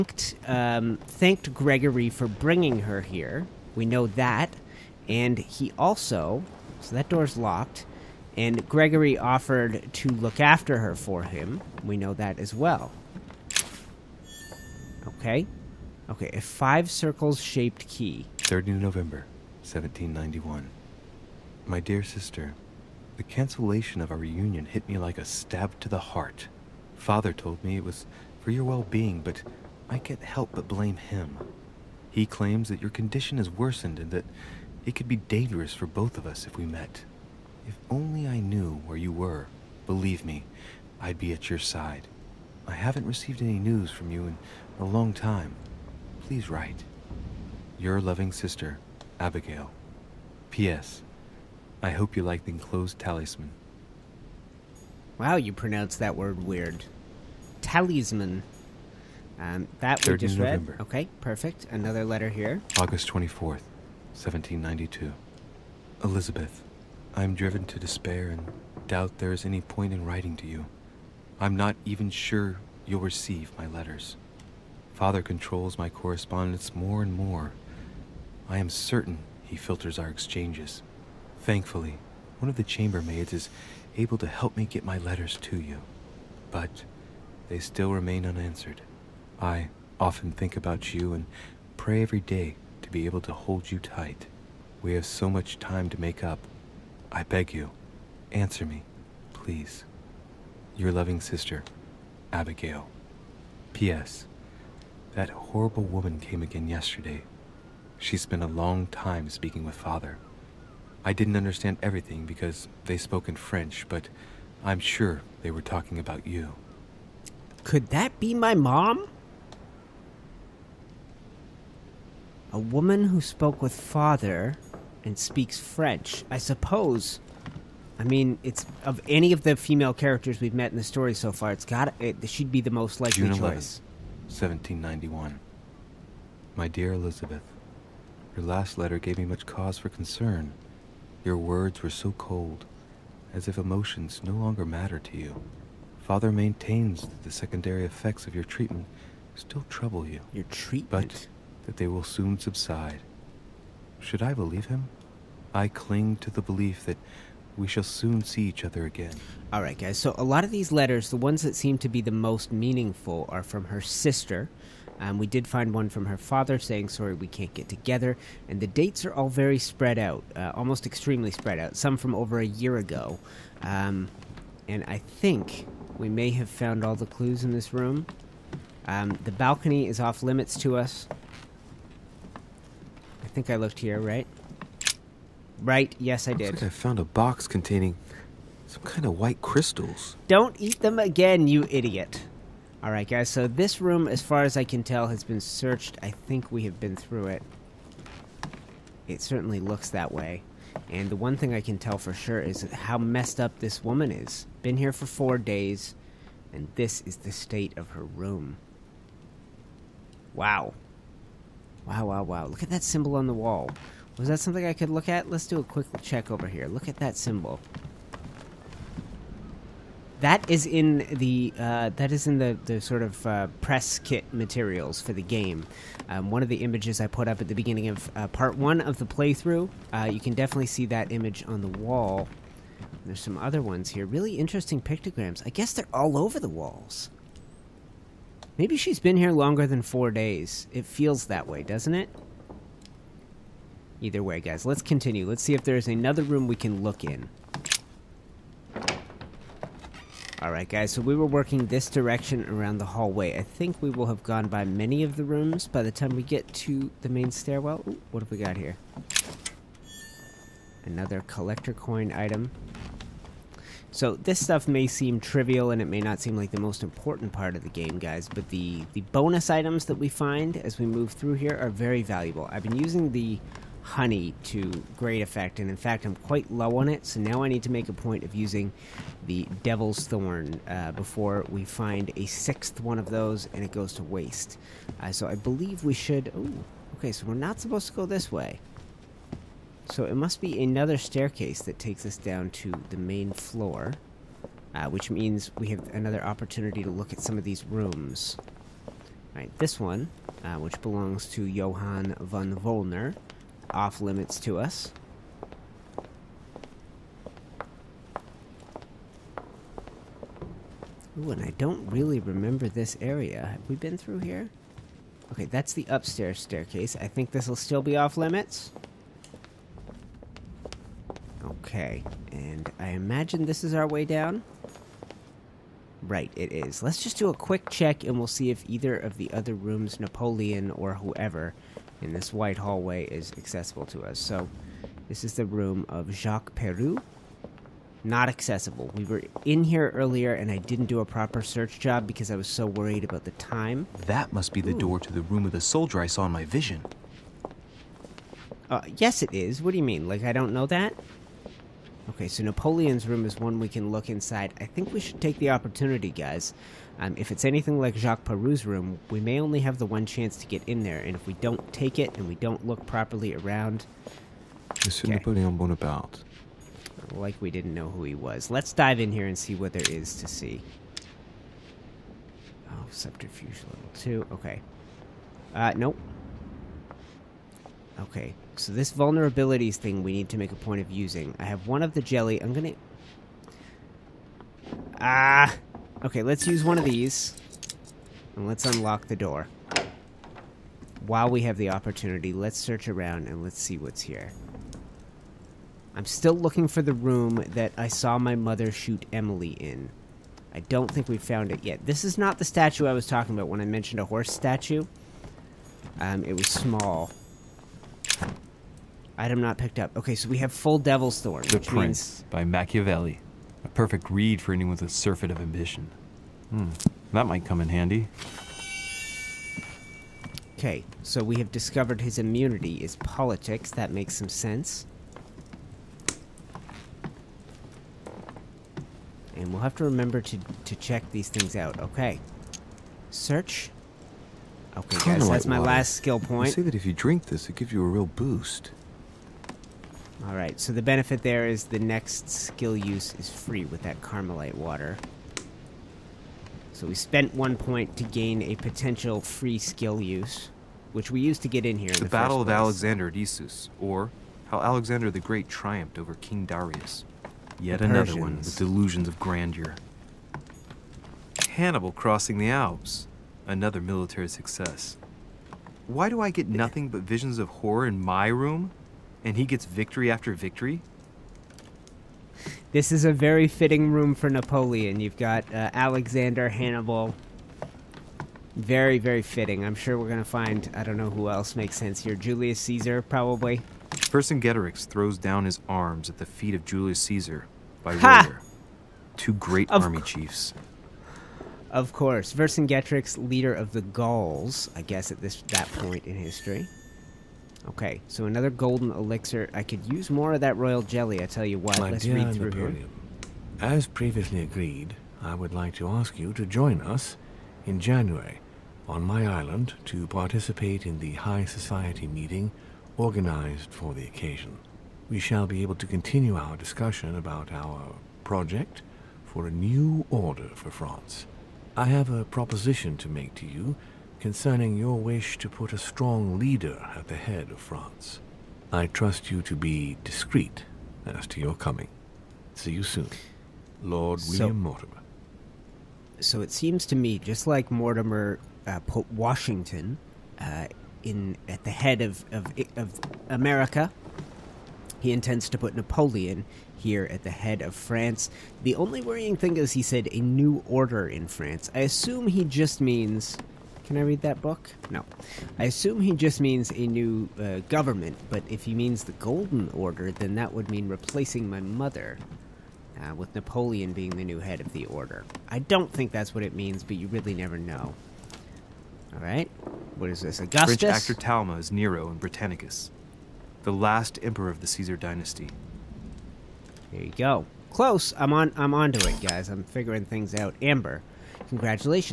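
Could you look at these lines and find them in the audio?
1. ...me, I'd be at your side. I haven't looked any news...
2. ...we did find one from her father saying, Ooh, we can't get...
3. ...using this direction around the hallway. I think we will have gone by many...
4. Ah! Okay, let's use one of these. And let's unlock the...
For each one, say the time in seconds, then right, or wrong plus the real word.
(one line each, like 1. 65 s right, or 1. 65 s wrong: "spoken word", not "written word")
1. 40 s wrong: "received", not "looked"
2. 165 s wrong: "Sorry", not "Ooh"
3. 251 s wrong: "working", not "using"
4. 384 s right.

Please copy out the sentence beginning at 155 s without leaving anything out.
I cling to the belief that we shall soon see each other again.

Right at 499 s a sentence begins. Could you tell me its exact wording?
I could use more of that royal jelly, I tell you what.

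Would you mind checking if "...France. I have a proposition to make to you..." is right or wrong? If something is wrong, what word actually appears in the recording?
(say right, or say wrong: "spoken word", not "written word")
right.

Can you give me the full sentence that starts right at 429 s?
And we'll have to remember to, to check these things out.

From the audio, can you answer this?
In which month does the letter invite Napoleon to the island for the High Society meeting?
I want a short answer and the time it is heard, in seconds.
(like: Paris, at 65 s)
January, at 507 s.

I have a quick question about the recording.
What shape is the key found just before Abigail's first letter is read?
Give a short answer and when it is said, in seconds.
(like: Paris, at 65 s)
Five circles shaped key, at 16 s.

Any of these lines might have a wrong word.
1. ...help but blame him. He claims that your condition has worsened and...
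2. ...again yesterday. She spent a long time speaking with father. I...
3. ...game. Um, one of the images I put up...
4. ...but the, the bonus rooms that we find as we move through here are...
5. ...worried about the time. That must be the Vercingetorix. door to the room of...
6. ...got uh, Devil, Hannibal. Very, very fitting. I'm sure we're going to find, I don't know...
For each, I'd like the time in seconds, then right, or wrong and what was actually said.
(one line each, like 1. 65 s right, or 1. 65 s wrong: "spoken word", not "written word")
1. 30 s right
2. 106 s right
3. 225 s right
4. 268 s wrong: "items", not "rooms"
5. 342 s wrong: "Ooh", not "Vercingetorix"
6. 475 s wrong: "Alexander", not "Devil".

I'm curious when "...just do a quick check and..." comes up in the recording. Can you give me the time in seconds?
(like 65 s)
327 s.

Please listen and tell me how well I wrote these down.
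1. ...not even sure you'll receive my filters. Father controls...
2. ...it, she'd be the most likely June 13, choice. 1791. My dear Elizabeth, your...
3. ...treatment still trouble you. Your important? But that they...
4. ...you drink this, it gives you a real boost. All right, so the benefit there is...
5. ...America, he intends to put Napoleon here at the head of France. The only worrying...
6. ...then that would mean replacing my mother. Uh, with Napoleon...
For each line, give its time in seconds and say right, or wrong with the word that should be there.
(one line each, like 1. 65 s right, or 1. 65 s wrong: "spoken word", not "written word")
1. 71 s wrong: "letters", not "filters"
2. 131 s wrong: "11", not "13"
3. 148 s wrong: "treatment", not "important"
4. 436 s right
5. 543 s right
6. 560 s right.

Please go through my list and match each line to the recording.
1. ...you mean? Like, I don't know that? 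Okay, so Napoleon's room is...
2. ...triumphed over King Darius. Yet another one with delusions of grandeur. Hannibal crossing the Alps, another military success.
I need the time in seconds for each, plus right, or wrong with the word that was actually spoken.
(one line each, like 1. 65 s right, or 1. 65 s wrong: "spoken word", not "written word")
1. 349 s right
2. 455 s right.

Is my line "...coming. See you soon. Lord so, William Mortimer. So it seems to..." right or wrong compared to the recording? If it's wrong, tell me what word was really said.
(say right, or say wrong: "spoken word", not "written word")
right.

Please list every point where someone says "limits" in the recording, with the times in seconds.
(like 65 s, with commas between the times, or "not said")
180 s, 303 s, 318 s.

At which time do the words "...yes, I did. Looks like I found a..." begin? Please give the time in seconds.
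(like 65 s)
185 s.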